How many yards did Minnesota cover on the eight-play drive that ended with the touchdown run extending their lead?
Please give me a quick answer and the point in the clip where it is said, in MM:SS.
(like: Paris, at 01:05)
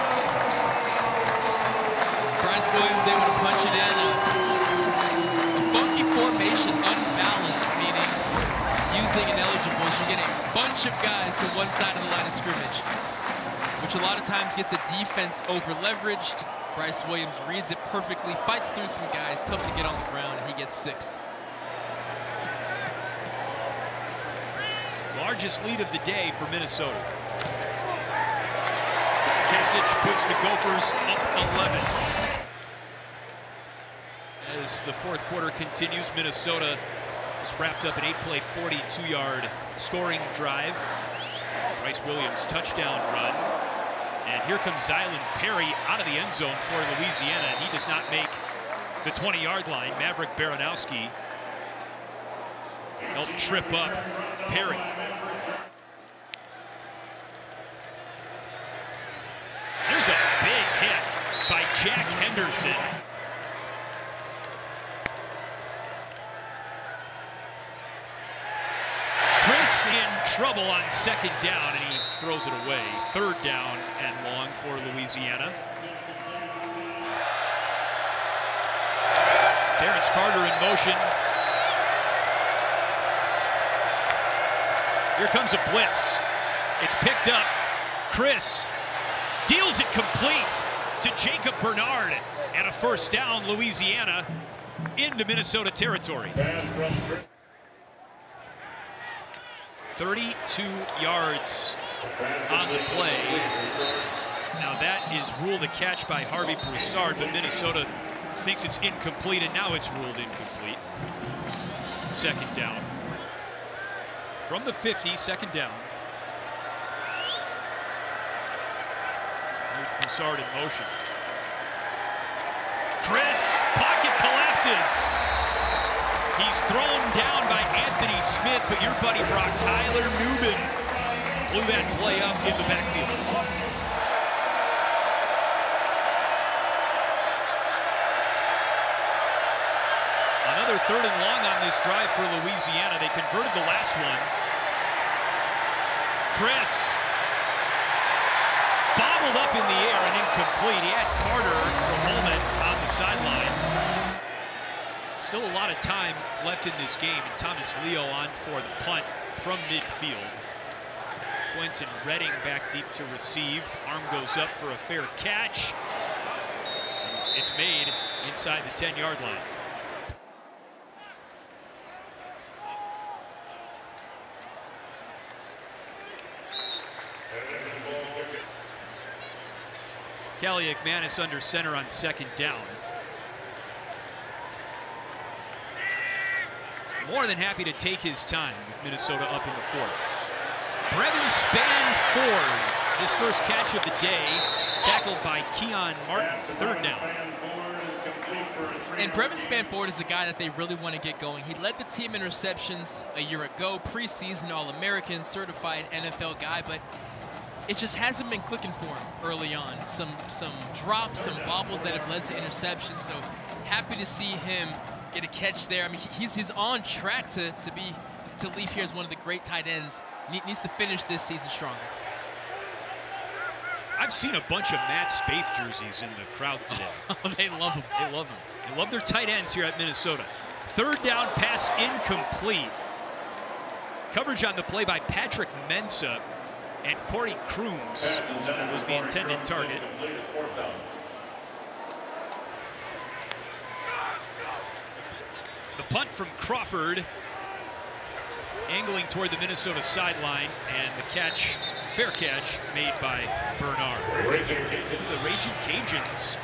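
42, at 00:38.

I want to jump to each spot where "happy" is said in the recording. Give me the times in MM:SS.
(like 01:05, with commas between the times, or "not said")
03:07, 03:33.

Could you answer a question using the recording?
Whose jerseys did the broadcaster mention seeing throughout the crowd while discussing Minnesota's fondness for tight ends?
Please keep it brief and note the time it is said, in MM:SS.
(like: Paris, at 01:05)
Matt Spaeth, at 03:44.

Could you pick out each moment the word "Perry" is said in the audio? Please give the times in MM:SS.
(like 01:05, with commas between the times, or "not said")
00:45, 00:54.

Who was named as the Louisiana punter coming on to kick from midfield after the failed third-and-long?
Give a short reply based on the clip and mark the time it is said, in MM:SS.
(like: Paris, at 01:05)
Thomas Leo, at 02:37.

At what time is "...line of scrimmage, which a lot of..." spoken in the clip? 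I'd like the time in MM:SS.
00:12.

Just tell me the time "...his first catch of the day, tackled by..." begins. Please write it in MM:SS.
03:12.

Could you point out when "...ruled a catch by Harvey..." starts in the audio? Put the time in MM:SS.
01:45.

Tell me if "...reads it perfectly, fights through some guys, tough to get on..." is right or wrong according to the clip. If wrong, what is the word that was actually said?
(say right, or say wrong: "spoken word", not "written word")
right.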